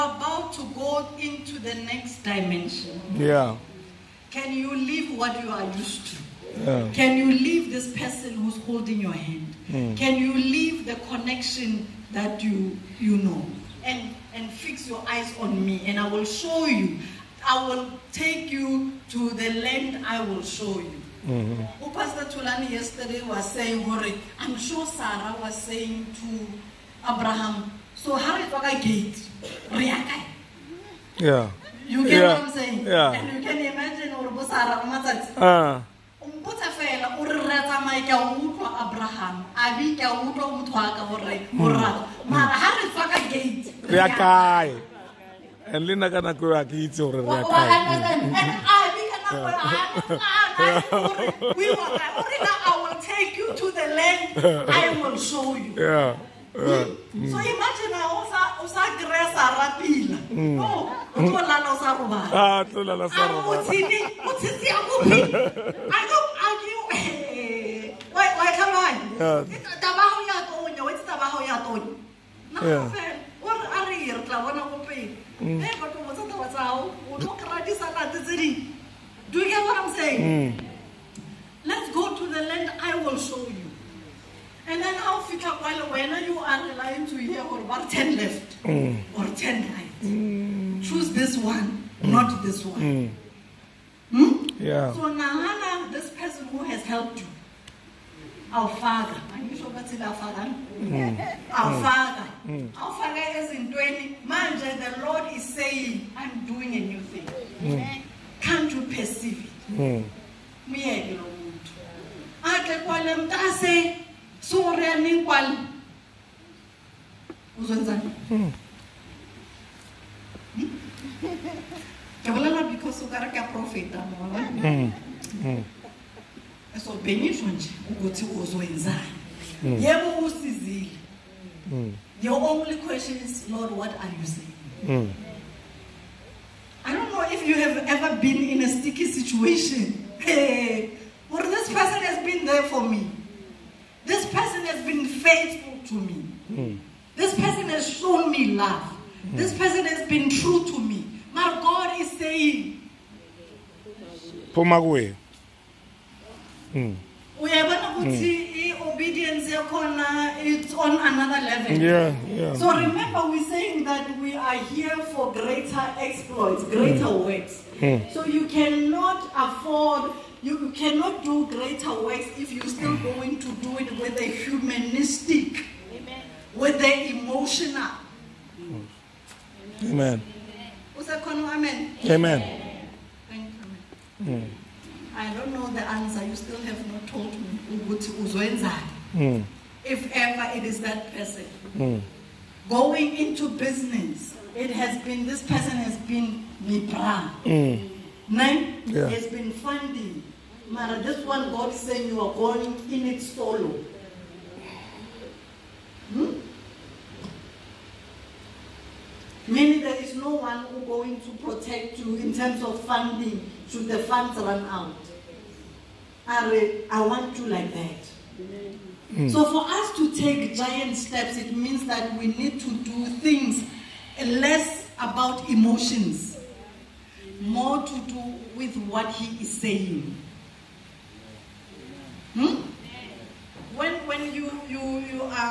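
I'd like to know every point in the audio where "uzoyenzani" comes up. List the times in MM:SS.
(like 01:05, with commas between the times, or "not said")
02:08.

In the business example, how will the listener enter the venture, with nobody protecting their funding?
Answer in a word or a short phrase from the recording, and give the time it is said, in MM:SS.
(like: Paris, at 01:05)
solo, at 03:23.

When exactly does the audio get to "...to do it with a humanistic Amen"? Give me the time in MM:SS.
02:53.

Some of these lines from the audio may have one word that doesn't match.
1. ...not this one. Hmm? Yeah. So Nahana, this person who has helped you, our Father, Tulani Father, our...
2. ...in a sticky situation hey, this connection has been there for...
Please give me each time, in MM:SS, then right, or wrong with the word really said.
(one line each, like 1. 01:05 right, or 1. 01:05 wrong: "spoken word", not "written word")
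1. 01:32 wrong: "Our", not "Tulani"
2. 02:18 wrong: "person", not "connection".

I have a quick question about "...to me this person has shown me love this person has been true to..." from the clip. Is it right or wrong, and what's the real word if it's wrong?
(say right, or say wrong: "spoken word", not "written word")
right.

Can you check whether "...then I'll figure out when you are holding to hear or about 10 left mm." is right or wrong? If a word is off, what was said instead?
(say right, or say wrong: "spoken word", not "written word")
wrong: "relying", not "holding".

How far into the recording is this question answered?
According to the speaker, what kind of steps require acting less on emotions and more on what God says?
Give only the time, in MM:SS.
03:40.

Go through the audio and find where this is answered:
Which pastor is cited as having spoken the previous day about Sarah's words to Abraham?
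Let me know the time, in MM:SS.
00:21.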